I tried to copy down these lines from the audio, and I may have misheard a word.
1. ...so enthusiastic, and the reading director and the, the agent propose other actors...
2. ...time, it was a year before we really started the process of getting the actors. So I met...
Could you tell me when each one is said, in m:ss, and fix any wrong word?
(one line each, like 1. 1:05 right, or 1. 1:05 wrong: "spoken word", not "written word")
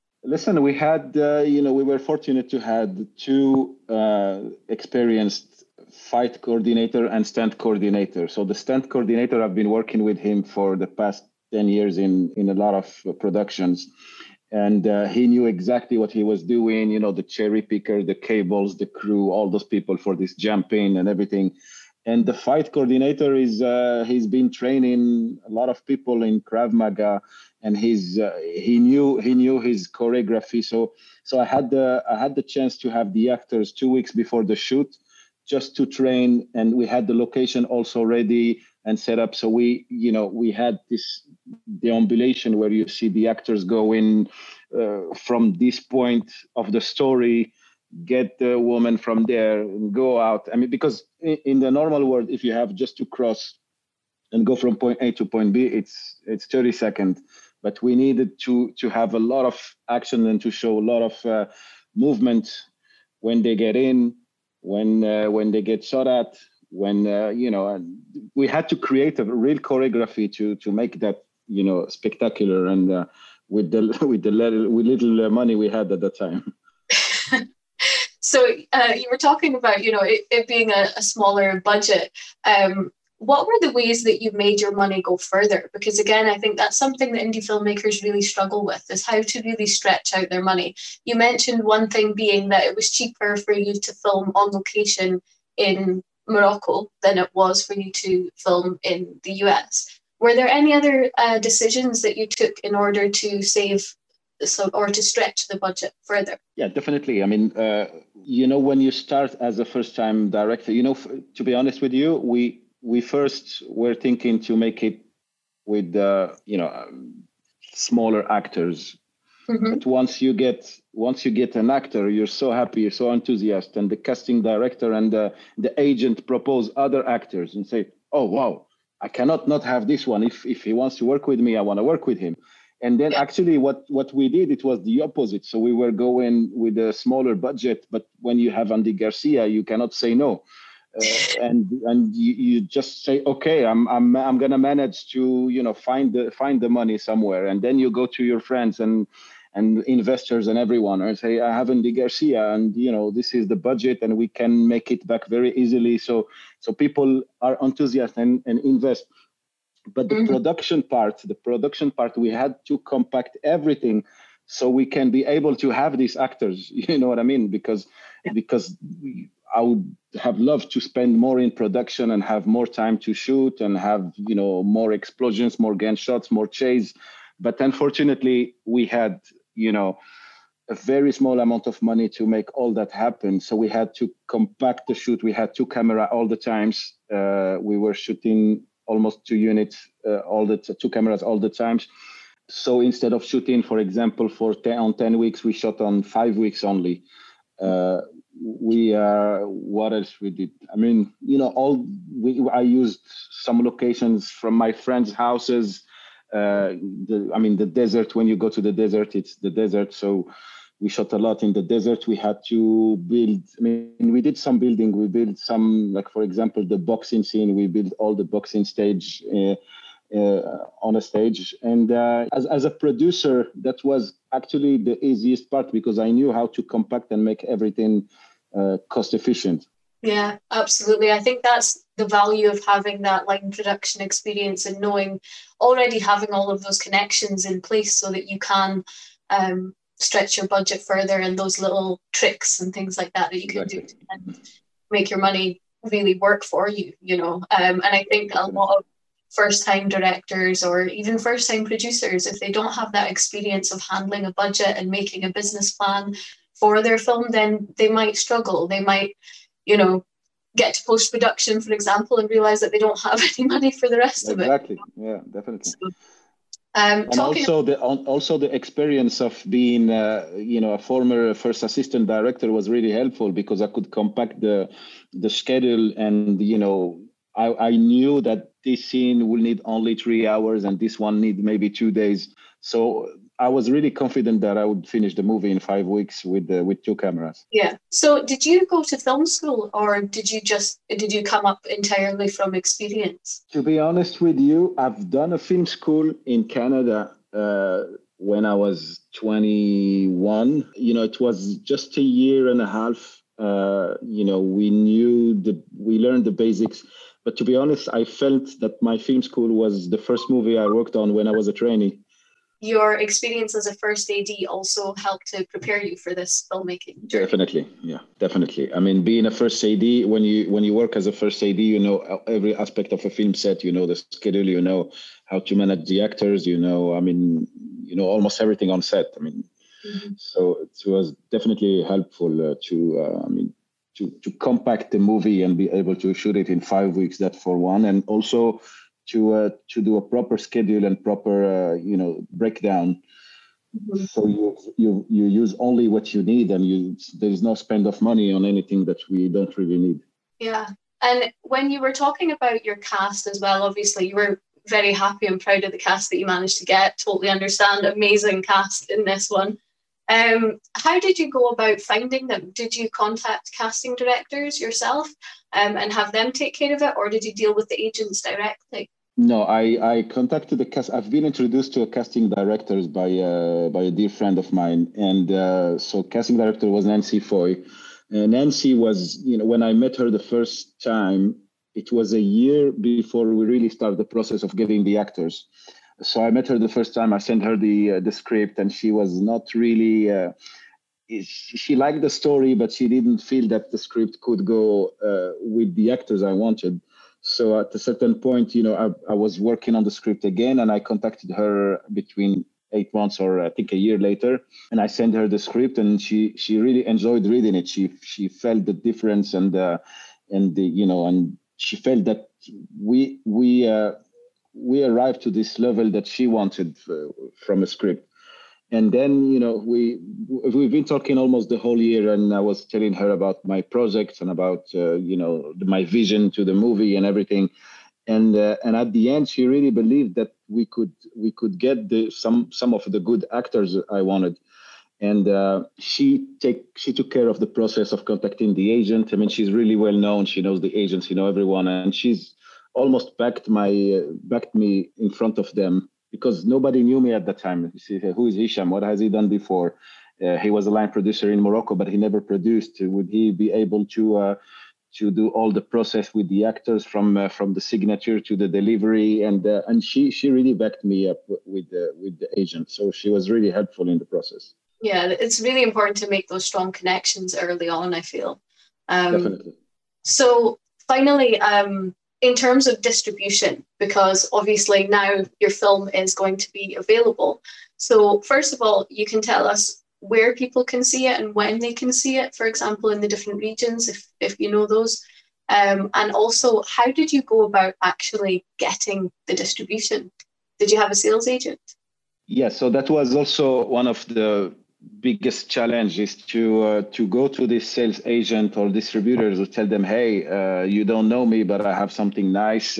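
1. 2:03 wrong: "casting", not "reading"
2. 6:20 right.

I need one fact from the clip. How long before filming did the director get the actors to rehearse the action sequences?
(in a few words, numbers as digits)
2 weeks.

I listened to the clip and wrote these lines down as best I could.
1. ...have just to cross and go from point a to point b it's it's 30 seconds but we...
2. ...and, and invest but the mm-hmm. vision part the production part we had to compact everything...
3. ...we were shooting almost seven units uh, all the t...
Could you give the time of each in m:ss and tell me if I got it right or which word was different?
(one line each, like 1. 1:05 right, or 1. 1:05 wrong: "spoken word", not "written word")
1. 0:52 right
2. 2:38 wrong: "production", not "vision"
3. 3:07 wrong: "two", not "seven".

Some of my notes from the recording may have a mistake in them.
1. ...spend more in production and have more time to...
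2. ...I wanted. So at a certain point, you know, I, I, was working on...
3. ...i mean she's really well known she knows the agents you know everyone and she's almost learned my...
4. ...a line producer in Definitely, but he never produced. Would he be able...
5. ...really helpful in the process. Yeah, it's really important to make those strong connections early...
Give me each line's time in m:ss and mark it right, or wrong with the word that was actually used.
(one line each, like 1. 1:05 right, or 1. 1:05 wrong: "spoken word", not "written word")
1. 2:50 right
2. 6:36 right
3. 7:19 wrong: "backed", not "learned"
4. 7:30 wrong: "Morocco", not "Definitely"
5. 7:43 right.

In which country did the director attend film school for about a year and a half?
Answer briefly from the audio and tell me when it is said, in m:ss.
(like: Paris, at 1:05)
Canada, at 4:56.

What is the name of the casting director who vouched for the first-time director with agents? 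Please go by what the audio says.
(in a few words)
Nancy Foy.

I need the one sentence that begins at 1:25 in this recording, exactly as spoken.
Because again, I think that's something that indie filmmakers really struggle with is how to really stretch out their money.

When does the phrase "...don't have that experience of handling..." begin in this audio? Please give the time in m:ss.
4:12.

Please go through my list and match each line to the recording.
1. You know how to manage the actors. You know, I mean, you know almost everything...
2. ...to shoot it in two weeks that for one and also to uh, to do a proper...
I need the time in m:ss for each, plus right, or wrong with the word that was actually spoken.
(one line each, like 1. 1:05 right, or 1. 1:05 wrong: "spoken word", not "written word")
1. 5:24 right
2. 5:35 wrong: "five", not "two".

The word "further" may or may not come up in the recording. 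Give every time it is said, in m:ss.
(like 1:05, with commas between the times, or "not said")
1:25, 1:46, 4:00.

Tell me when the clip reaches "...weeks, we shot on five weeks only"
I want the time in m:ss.
3:15.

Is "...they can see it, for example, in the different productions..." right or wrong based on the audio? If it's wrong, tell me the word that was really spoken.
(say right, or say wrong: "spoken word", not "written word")
wrong: "regions", not "productions".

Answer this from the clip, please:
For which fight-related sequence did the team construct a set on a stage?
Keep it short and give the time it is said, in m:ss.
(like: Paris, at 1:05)
the boxing scene, at 3:36.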